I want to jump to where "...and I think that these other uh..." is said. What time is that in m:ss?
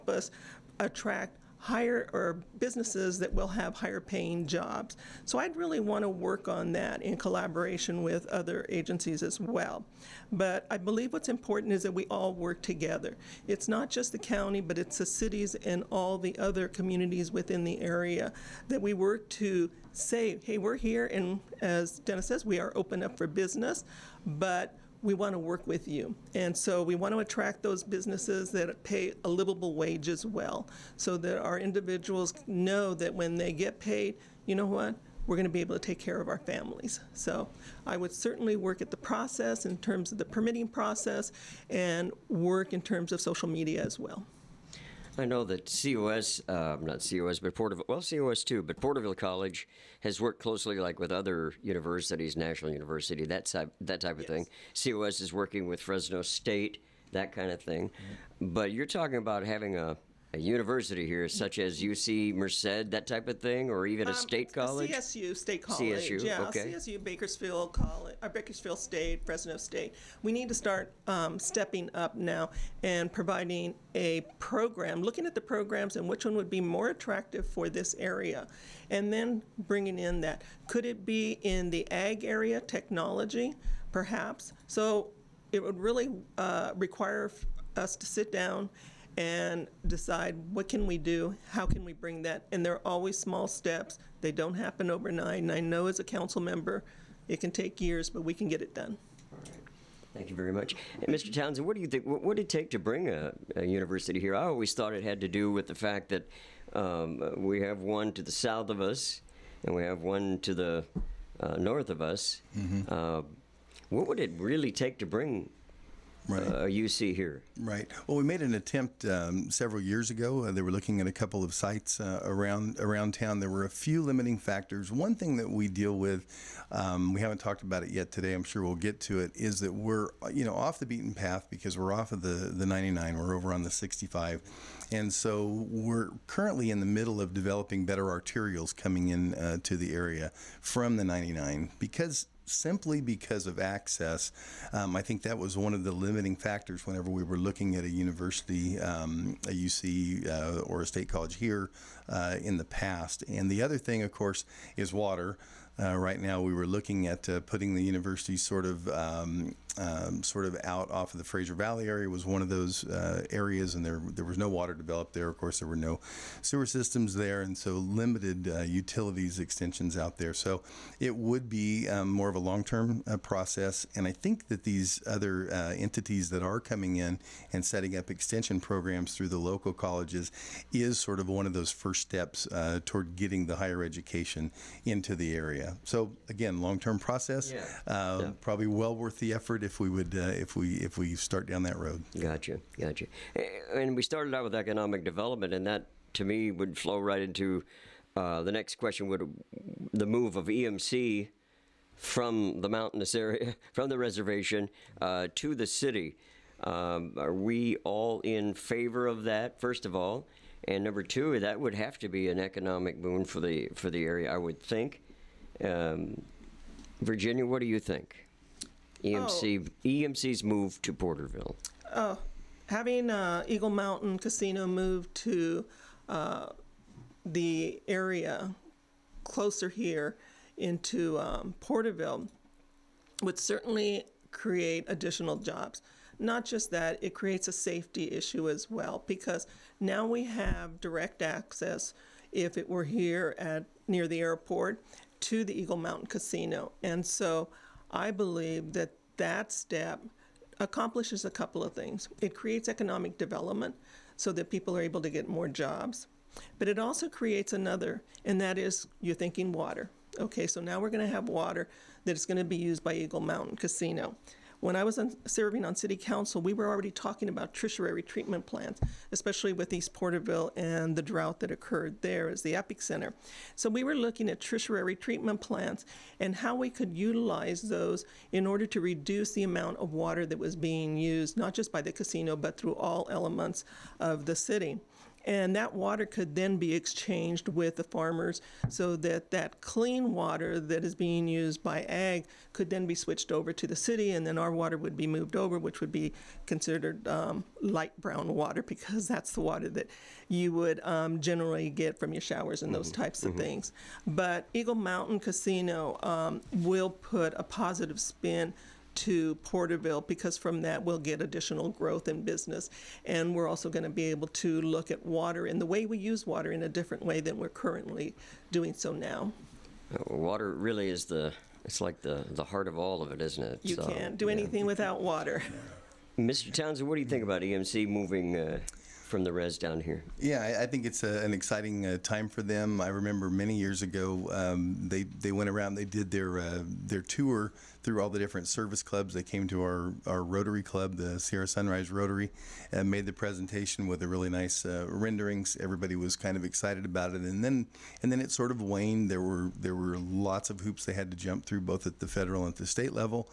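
2:53.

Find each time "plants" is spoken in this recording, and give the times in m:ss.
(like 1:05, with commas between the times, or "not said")
4:28, 4:35.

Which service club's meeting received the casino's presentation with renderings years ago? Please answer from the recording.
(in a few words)
Sierra Sunrise Rotary.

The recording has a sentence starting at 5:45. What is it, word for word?
Everybody was kind of excited about it, and then and then it sort of waned.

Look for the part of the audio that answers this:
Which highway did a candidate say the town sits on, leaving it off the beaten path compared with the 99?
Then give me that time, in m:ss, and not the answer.
2:13.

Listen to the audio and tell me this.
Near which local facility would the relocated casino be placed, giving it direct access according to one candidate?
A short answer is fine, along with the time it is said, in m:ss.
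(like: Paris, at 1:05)
the airport, at 4:04.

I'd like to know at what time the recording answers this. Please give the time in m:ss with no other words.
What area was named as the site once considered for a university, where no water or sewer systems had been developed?
2:41.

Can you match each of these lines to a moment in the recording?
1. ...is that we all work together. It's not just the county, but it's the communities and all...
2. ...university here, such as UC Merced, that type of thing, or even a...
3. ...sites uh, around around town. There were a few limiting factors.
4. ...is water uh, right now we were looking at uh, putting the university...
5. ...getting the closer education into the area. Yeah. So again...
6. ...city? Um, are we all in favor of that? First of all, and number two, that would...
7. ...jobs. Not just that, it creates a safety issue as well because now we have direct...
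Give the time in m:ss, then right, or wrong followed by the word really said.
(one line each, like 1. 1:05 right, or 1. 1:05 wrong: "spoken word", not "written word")
1. 0:11 wrong: "cities", not "communities"
2. 1:00 right
3. 2:01 right
4. 2:34 right
5. 3:03 wrong: "higher", not "closer"
6. 3:25 right
7. 3:55 right.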